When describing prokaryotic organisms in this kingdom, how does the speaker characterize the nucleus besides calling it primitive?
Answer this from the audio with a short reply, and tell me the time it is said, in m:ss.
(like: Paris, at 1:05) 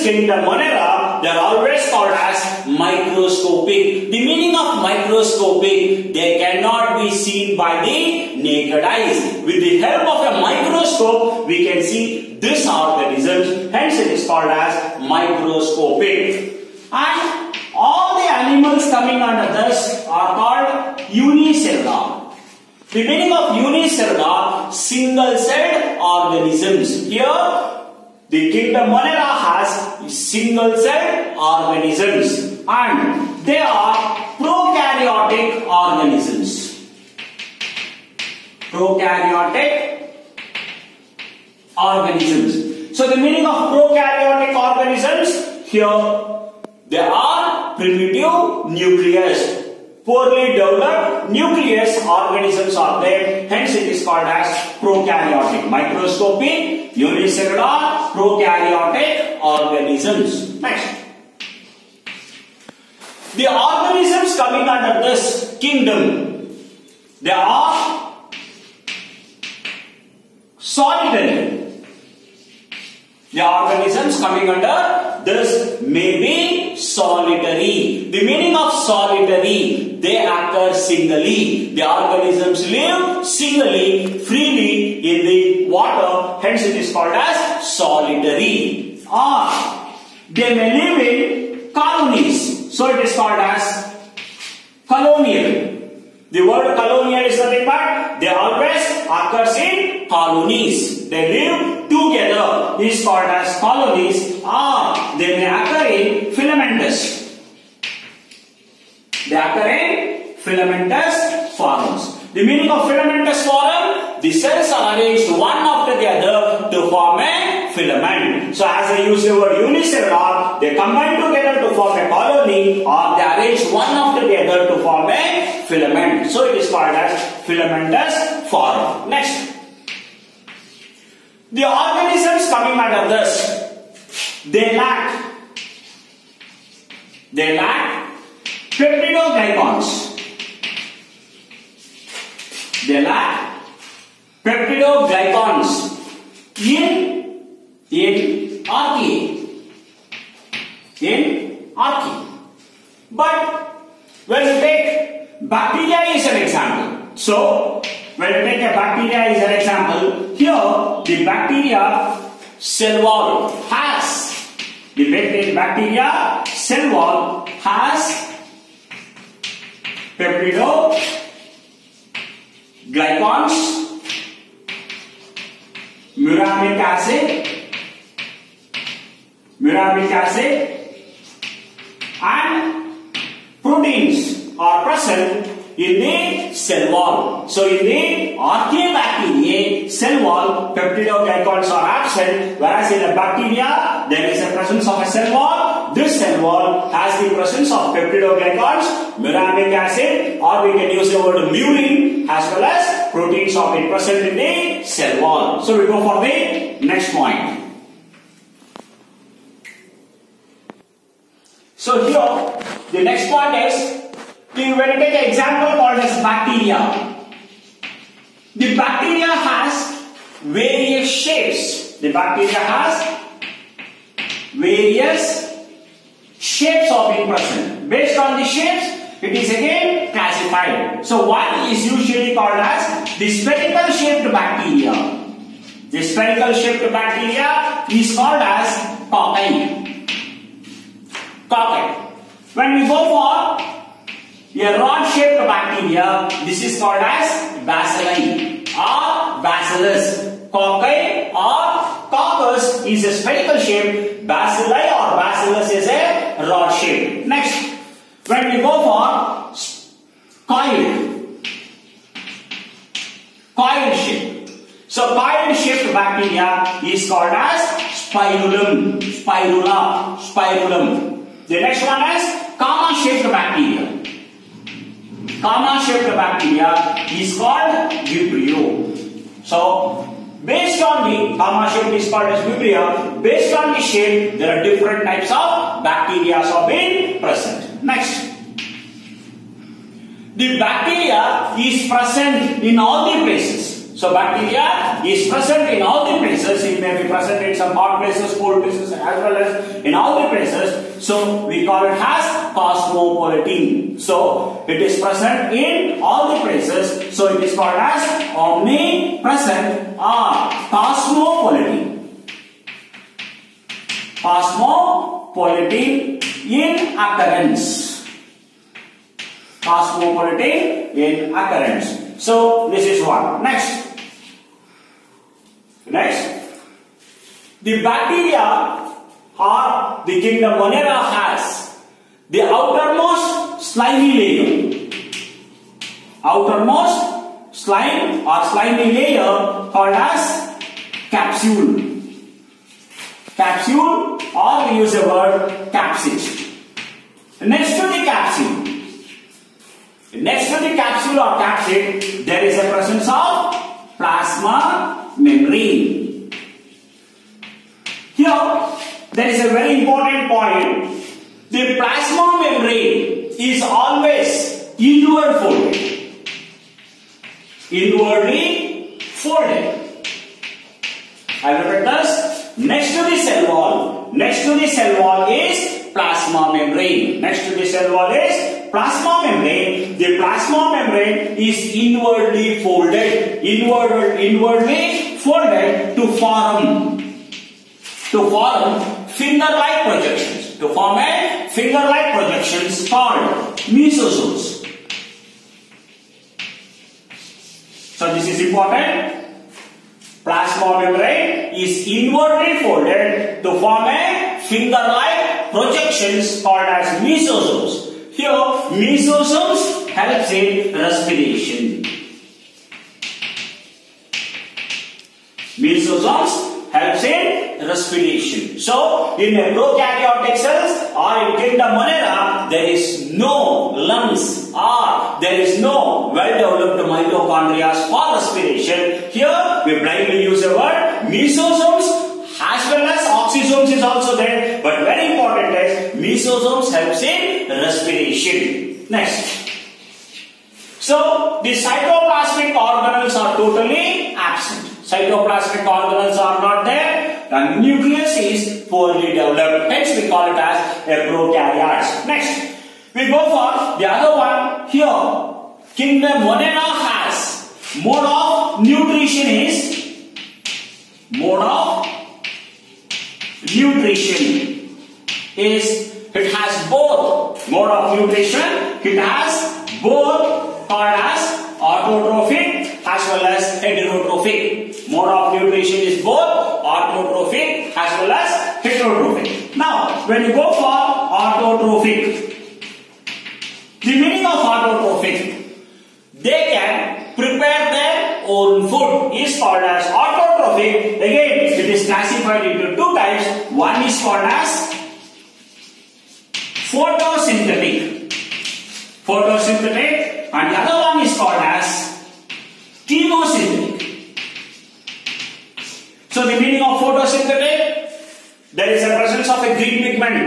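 Poorly developed nucleus, at 0:50.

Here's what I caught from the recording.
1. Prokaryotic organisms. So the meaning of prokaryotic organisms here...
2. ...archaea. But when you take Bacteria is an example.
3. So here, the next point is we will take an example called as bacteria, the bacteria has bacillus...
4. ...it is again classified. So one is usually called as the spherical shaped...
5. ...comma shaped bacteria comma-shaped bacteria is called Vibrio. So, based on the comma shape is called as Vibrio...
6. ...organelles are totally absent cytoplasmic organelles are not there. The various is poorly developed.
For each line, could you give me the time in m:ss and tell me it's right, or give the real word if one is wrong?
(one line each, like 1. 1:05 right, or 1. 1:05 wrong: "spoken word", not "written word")
1. 0:38 right
2. 2:31 right
3. 3:31 wrong: "various", not "bacillus"
4. 3:49 right
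5. 4:32 right
6. 7:22 wrong: "nucleus", not "various".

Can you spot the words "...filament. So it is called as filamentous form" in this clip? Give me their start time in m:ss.
2:05.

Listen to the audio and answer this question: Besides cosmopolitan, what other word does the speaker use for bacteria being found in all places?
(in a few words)
Omnipresent.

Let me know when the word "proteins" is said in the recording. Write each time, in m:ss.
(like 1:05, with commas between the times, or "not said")
3:03, 3:23.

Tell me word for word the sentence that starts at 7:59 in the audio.
Now, when you go for autotrophic, the meaning of autotrophic, they can prepare their own food is called as autotrophic.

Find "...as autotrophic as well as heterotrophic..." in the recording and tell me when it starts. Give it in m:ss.
7:51.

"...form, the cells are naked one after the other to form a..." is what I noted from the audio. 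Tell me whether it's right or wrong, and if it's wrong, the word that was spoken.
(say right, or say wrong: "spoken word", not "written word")
wrong: "arranged", not "naked".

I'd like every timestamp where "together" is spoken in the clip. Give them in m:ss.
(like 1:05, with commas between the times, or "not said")
1:41, 2:01.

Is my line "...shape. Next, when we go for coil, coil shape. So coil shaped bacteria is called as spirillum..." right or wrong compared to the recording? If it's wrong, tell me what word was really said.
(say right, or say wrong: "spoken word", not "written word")
right.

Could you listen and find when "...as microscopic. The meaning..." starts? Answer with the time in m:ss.
0:02.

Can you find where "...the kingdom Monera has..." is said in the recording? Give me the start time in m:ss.
0:28.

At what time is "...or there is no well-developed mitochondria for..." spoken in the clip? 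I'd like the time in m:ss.
7:04.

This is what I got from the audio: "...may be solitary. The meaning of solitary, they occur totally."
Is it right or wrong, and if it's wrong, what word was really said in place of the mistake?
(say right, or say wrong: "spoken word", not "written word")
wrong: "singly", not "totally".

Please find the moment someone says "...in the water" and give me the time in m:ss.
1:24.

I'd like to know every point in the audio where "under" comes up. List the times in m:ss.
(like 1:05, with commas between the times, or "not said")
0:19, 1:04, 1:14, 2:12.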